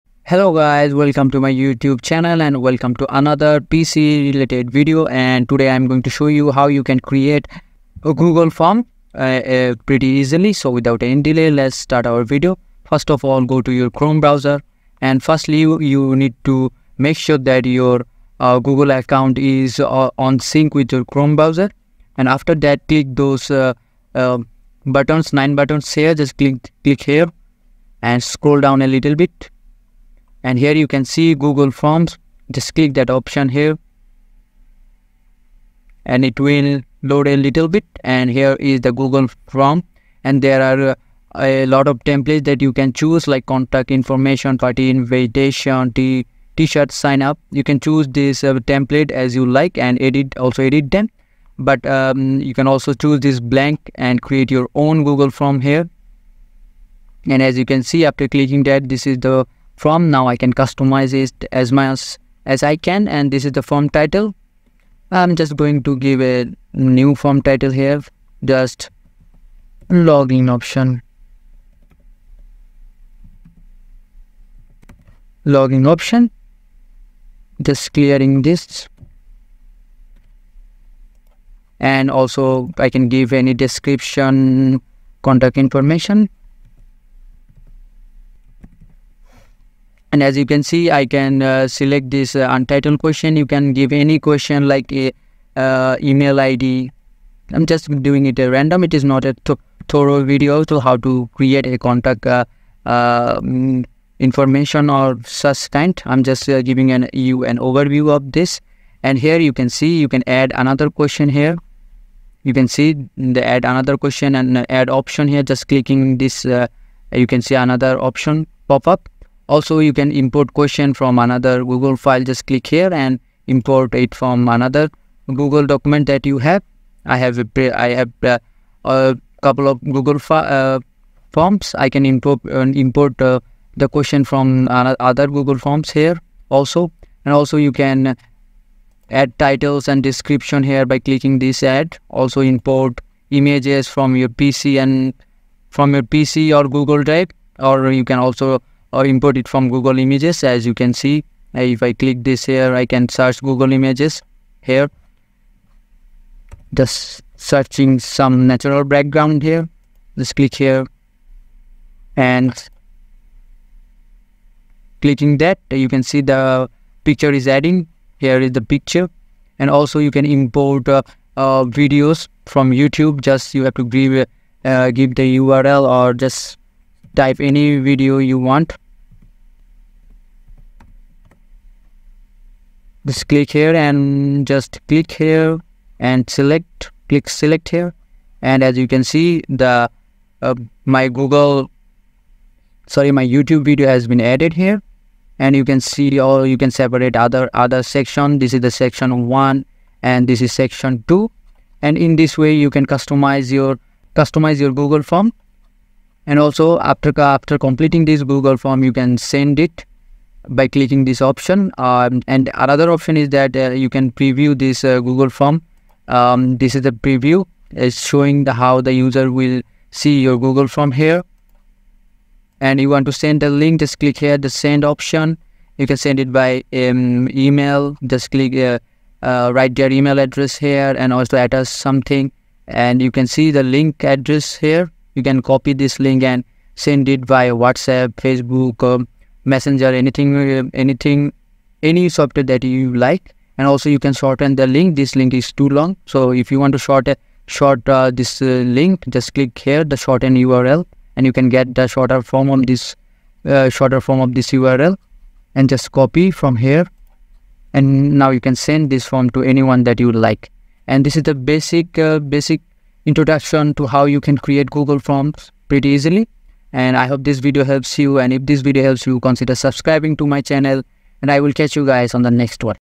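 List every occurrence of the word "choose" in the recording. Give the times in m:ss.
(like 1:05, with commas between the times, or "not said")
0:42, 0:47, 0:52.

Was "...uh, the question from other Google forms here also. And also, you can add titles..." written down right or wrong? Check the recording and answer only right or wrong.
right.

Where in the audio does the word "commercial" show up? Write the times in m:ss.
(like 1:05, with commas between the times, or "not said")
not said.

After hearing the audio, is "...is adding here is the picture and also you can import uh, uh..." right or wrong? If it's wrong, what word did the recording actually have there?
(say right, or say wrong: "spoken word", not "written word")
right.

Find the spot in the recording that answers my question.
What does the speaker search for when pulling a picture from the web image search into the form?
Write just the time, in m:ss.
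2:38.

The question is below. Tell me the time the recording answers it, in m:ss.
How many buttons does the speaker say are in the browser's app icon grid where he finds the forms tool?
0:25.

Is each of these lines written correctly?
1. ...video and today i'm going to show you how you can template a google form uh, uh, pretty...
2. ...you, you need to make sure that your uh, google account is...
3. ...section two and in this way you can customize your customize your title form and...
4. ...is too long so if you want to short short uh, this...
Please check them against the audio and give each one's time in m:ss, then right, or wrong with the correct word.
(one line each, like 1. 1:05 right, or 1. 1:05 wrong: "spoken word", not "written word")
1. 0:04 wrong: "create", not "template"
2. 0:15 right
3. 3:20 wrong: "google", not "title"
4. 4:05 right.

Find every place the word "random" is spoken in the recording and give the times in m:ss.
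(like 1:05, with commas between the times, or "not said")
1:38.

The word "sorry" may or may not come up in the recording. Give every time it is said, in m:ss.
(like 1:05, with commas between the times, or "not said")
3:12.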